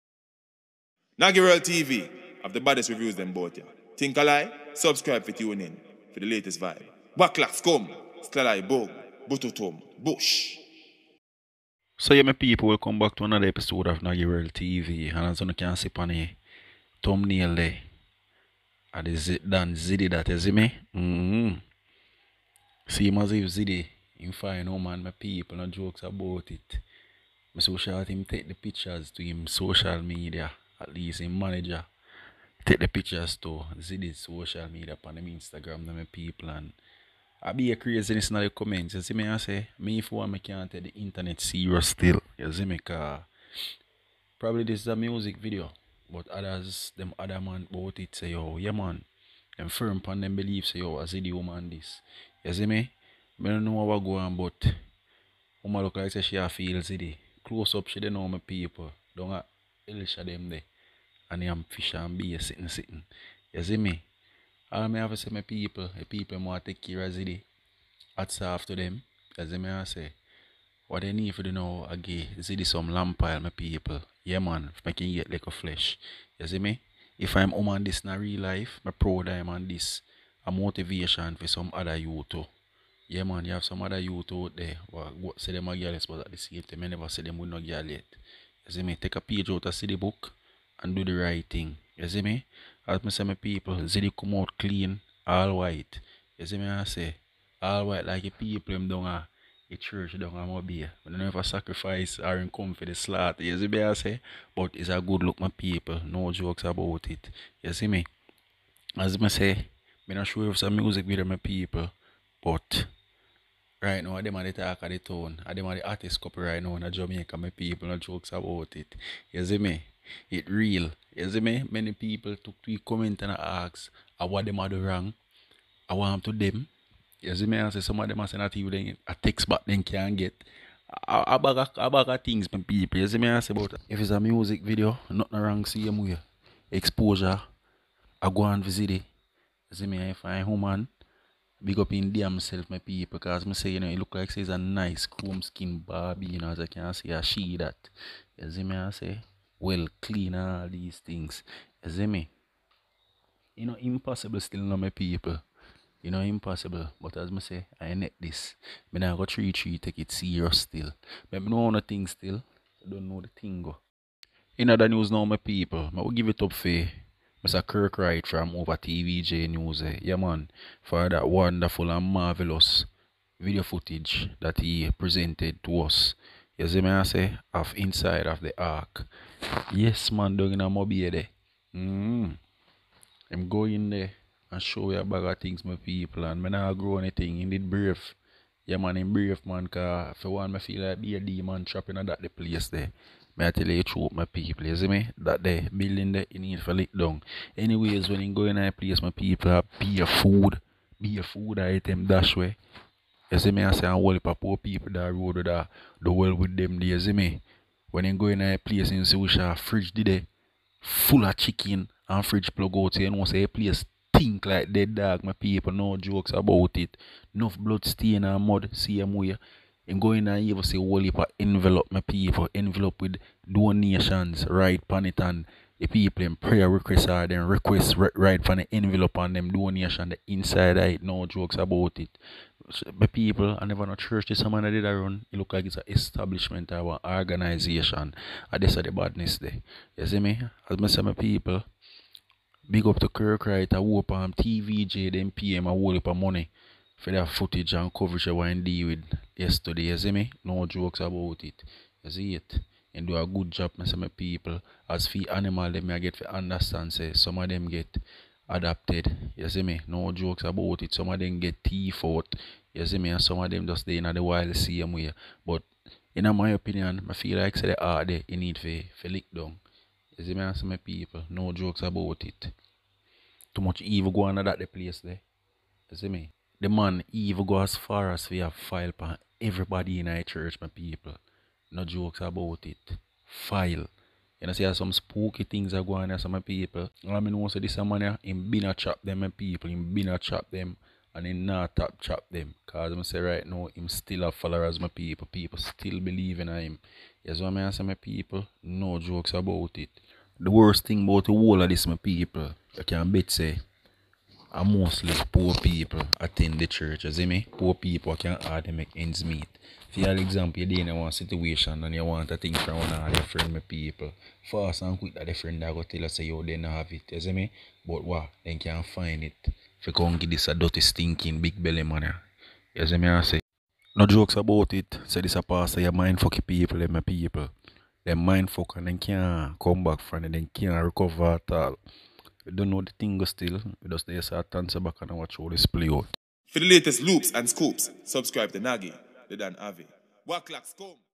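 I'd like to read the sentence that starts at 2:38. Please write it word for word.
When now go three three take it serious still.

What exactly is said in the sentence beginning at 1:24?
Well, what say them a girl, but at the same time, I never say them with no girl yet.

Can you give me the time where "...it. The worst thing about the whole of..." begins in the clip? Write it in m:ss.
4:59.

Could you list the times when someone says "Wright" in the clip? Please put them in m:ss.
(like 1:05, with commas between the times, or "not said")
2:47, 4:03.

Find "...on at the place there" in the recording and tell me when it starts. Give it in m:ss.
4:34.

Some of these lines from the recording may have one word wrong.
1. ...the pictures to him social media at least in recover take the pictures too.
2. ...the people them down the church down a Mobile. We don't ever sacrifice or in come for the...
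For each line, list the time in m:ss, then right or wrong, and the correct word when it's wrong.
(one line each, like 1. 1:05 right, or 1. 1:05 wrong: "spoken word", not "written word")
1. 0:28 wrong: "manager", not "recover"
2. 1:38 right.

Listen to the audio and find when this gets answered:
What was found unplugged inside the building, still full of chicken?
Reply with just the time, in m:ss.
3:32.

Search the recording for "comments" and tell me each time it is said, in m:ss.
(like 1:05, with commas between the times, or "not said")
0:38, 2:02.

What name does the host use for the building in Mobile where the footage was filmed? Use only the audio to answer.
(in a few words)
The ark.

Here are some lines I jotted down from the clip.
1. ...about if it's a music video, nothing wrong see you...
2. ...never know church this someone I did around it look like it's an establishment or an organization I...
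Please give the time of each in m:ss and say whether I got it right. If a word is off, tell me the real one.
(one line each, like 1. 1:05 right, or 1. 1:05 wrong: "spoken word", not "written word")
1. 2:13 right
2. 3:53 right.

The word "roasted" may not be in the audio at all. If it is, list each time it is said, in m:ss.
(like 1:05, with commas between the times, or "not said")
not said.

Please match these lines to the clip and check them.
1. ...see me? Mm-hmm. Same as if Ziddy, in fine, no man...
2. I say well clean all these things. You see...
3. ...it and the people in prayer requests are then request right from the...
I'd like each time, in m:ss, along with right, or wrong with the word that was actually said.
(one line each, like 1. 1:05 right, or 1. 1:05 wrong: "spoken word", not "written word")
1. 0:20 right
2. 2:28 right
3. 3:45 right.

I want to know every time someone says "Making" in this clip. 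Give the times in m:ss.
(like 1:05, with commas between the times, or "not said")
1:14.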